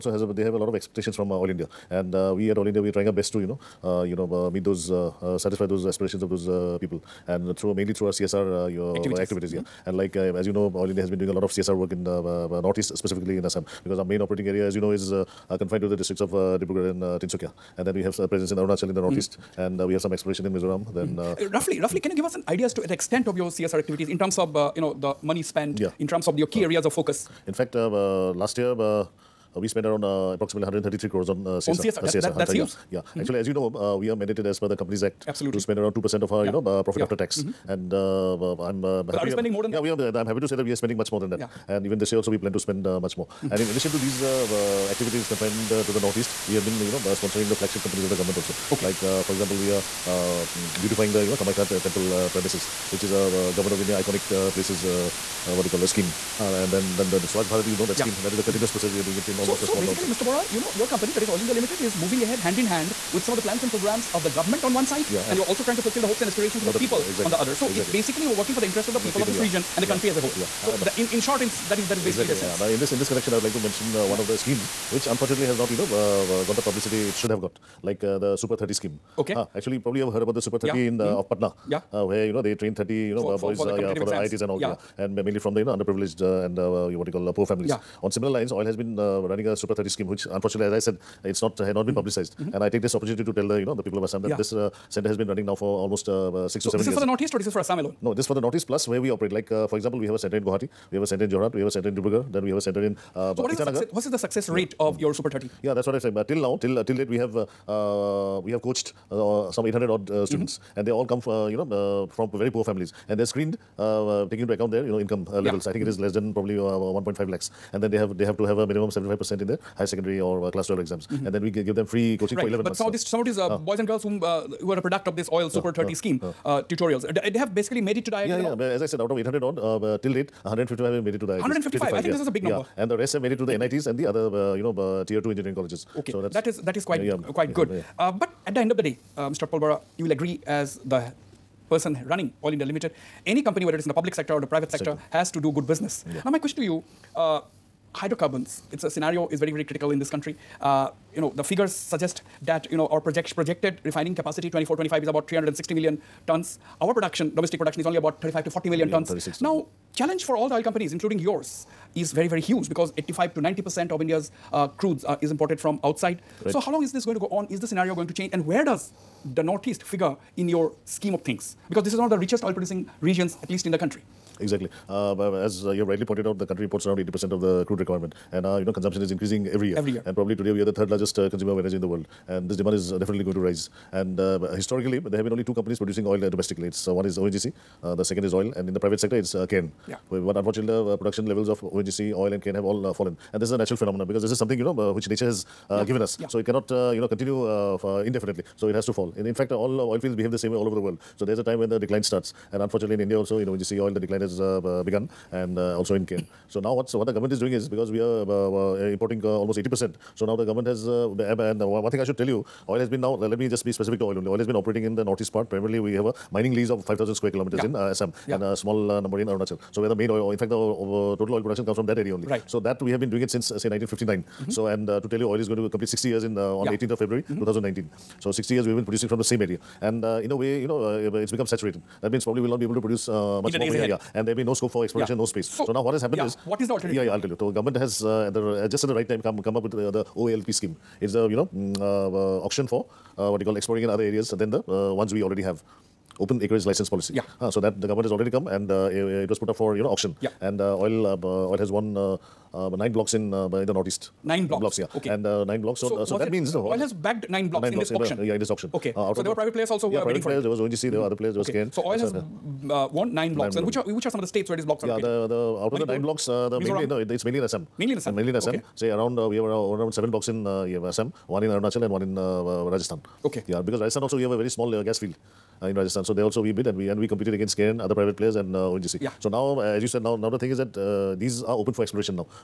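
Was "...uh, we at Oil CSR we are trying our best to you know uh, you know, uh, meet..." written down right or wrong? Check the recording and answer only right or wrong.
wrong.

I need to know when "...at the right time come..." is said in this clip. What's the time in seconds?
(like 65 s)
238 s.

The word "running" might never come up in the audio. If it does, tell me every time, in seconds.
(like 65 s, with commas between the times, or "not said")
89 s, 95 s, 142 s.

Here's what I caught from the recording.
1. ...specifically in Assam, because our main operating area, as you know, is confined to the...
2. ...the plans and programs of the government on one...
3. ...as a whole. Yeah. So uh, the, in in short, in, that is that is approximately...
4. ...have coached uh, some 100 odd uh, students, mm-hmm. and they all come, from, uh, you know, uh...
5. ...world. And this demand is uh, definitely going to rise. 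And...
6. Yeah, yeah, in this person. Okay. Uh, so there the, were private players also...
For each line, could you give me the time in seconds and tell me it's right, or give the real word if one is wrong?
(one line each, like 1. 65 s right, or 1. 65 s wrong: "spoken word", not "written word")
1. 12 s right
2. 63 s right
3. 70 s wrong: "basically", not "approximately"
4. 108 s wrong: "800", not "100"
5. 181 s right
6. 258 s wrong: "auction", not "person".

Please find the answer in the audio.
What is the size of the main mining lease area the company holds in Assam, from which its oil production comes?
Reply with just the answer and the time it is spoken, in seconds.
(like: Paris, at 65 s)
5,000 square kilometers, at 216 s.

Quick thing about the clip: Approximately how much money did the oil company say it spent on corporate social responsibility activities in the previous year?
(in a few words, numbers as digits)
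133 crores.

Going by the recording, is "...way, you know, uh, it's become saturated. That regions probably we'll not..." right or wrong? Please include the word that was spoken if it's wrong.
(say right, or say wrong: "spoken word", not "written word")
wrong: "means", not "regions".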